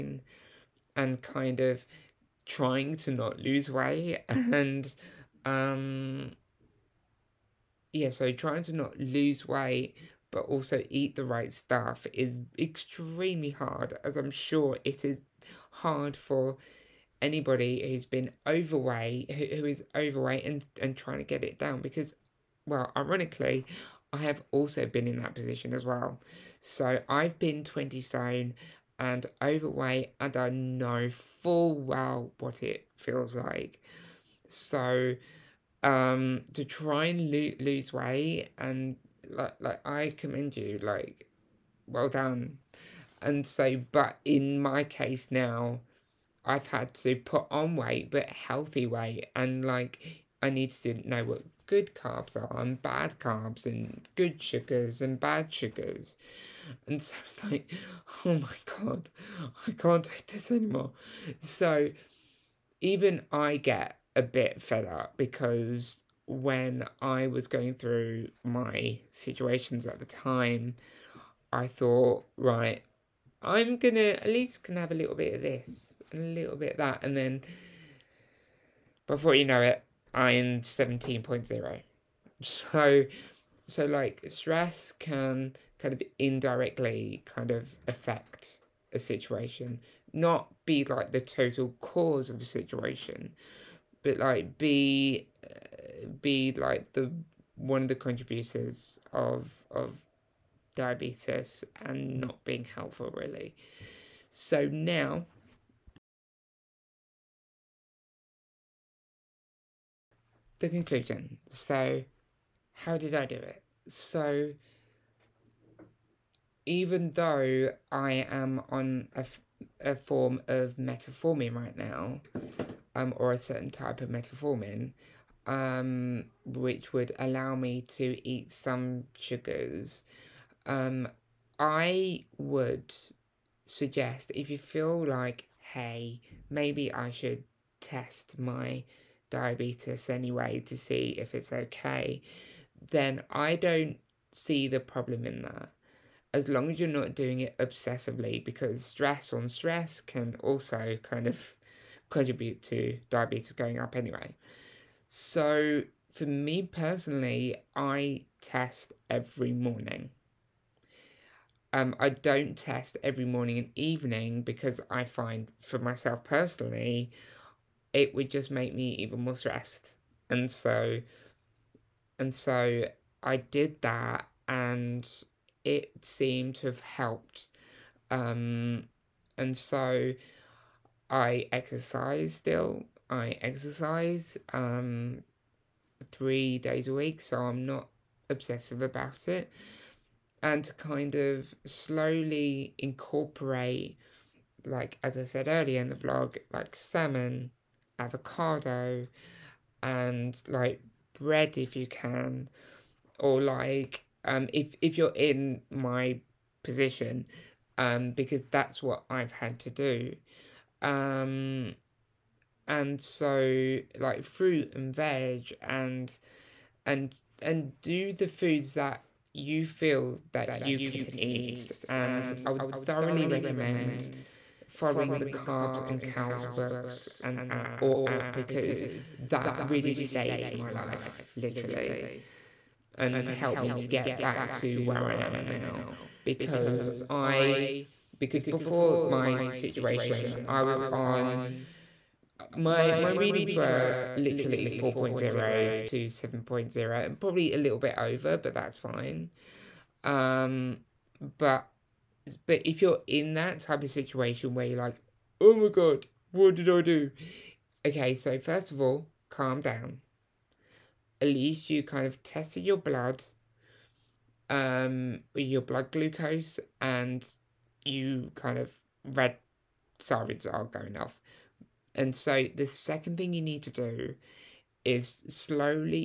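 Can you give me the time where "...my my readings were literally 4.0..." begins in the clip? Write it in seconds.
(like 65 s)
242 s.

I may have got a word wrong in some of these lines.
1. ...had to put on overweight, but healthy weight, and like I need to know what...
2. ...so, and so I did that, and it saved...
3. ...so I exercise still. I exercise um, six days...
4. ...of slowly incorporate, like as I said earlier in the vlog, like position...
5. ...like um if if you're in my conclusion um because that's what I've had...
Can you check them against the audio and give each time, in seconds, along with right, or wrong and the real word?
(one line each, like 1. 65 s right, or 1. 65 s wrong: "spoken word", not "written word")
1. 46 s wrong: "weight", not "overweight"
2. 170 s wrong: "seemed", not "saved"
3. 179 s wrong: "three", not "six"
4. 191 s wrong: "salmon", not "position"
5. 203 s wrong: "position", not "conclusion".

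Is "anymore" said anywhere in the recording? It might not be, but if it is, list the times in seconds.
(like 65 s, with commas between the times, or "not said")
60 s.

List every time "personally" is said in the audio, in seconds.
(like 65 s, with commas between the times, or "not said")
156 s, 166 s.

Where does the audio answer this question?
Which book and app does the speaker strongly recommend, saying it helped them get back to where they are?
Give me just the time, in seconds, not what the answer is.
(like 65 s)
225 s.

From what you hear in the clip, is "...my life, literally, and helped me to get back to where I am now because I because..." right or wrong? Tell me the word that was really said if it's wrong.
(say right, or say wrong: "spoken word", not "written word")
right.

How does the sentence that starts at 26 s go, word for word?
So I've been 20 stone and overweight, and I know full well what it feels like.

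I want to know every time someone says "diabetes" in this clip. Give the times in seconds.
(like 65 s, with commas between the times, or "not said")
100 s, 139 s, 153 s.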